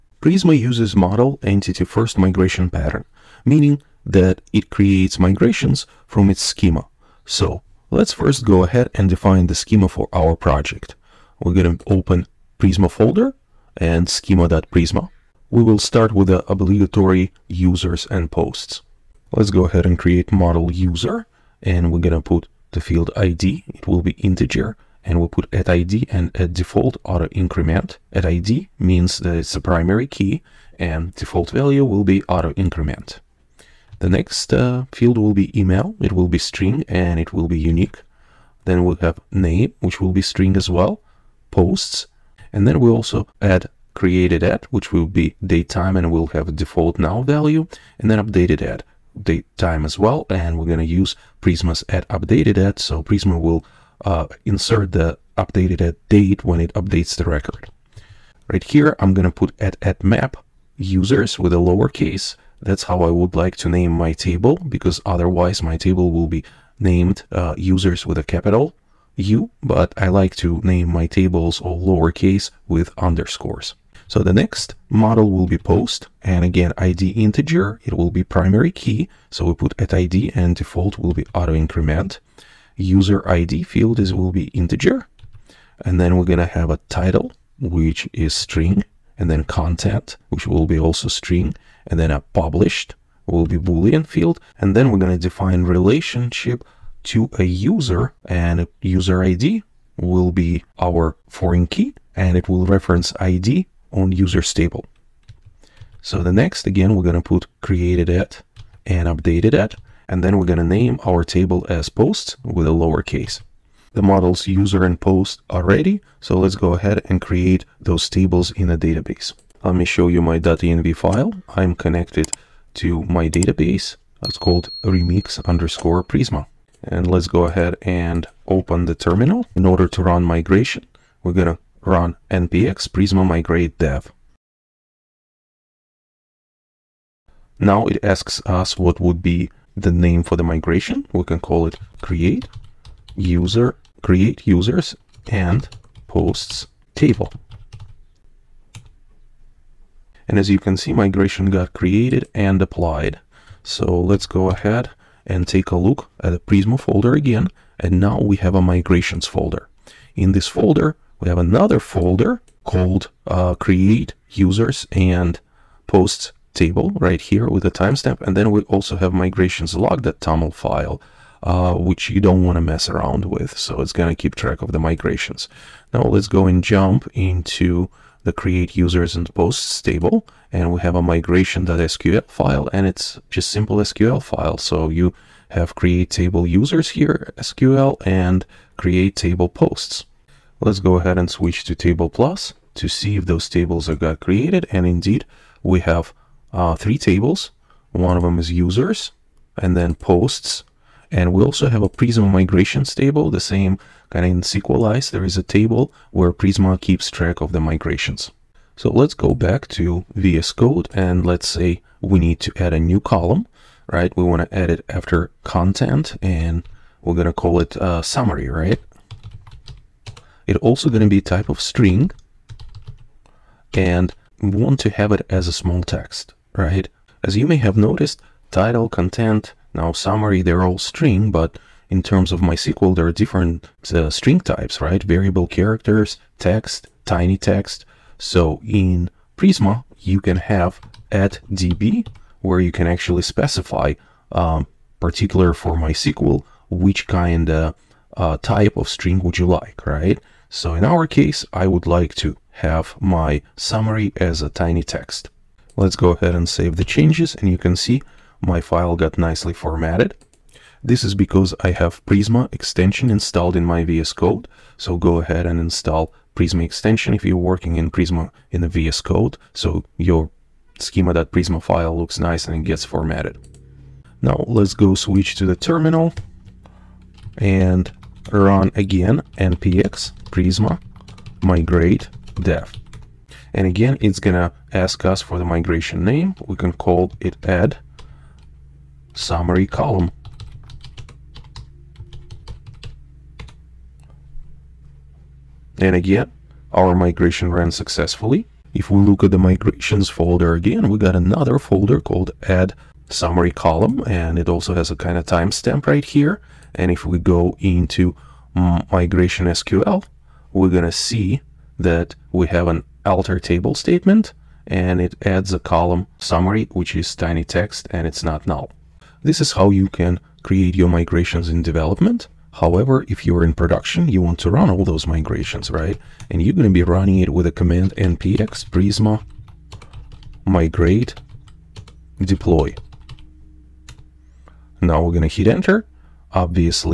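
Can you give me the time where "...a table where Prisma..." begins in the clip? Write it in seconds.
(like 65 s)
205 s.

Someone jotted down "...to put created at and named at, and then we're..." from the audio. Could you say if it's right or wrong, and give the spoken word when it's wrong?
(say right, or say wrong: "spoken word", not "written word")
wrong: "updated", not "named".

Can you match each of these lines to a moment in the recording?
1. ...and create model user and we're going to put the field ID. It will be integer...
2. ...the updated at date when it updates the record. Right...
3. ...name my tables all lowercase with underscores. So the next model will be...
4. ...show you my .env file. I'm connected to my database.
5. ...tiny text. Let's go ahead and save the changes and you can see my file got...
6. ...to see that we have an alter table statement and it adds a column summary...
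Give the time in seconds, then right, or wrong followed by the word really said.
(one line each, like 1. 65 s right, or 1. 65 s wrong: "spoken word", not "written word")
1. 19 s right
2. 54 s right
3. 70 s right
4. 119 s right
5. 254 s right
6. 310 s right.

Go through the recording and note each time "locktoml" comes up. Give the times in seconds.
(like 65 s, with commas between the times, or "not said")
169 s.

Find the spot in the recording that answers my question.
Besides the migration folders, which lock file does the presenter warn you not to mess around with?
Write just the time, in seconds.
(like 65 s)
169 s.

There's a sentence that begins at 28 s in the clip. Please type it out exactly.
At ID means that it's a primary key and default value will be auto increment.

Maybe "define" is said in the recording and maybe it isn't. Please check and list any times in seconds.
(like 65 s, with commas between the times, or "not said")
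9 s, 95 s.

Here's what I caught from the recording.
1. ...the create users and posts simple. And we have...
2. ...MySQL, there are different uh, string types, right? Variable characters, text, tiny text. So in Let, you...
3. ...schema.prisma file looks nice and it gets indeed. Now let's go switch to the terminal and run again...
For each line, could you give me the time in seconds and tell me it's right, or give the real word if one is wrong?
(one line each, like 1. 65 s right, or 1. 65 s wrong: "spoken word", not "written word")
1. 178 s wrong: "table", not "simple"
2. 232 s wrong: "Prisma", not "Let"
3. 270 s wrong: "formatted", not "indeed".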